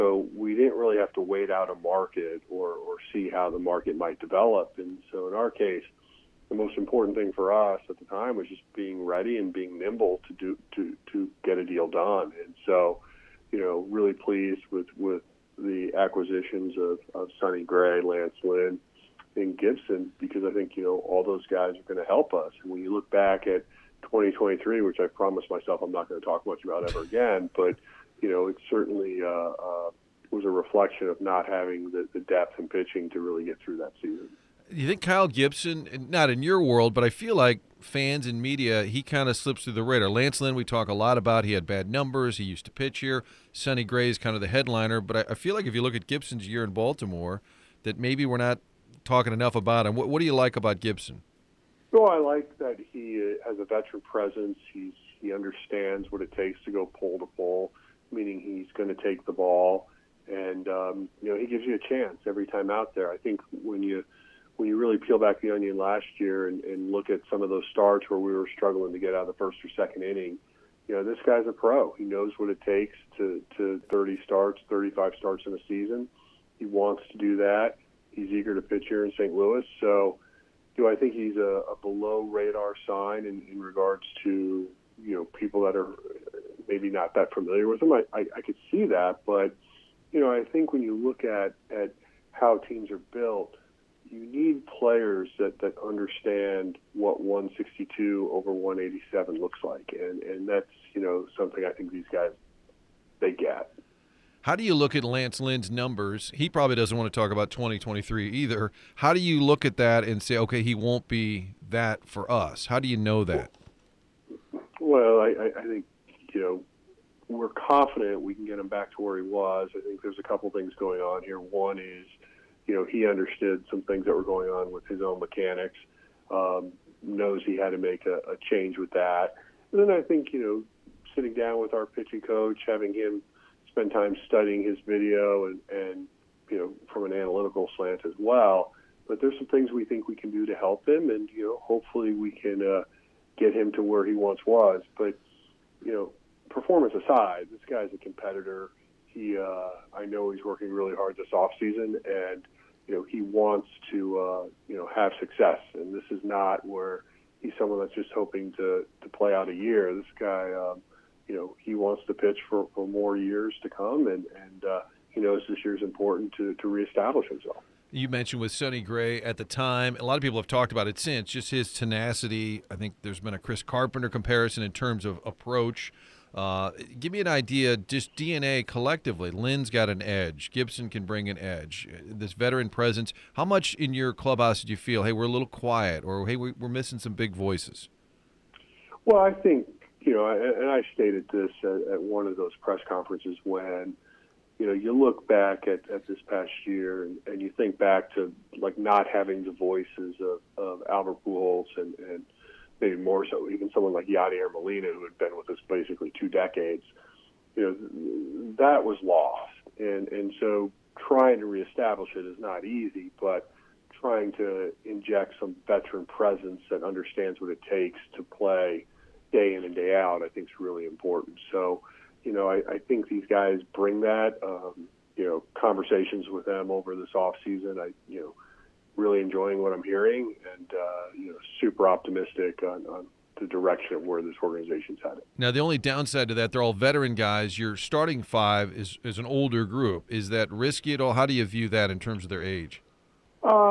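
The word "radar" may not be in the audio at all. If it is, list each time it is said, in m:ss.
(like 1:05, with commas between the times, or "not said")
0:39, 1:22.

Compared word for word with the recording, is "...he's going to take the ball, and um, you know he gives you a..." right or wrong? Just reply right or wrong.
right.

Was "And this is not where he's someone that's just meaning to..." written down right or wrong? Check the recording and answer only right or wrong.
wrong.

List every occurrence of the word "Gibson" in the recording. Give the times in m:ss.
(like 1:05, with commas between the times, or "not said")
0:19, 0:35, 0:46, 0:50, 3:00.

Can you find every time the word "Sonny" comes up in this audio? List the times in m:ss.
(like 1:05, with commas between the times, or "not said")
0:17, 0:43, 2:48.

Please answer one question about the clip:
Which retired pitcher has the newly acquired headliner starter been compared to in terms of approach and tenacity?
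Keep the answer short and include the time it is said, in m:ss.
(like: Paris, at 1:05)
Chris Carpenter, at 2:53.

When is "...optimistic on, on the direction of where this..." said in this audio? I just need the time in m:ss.
3:51.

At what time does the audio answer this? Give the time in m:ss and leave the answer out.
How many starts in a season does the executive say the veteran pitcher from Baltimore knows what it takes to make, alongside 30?
1:14.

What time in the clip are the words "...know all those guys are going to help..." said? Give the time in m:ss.
0:20.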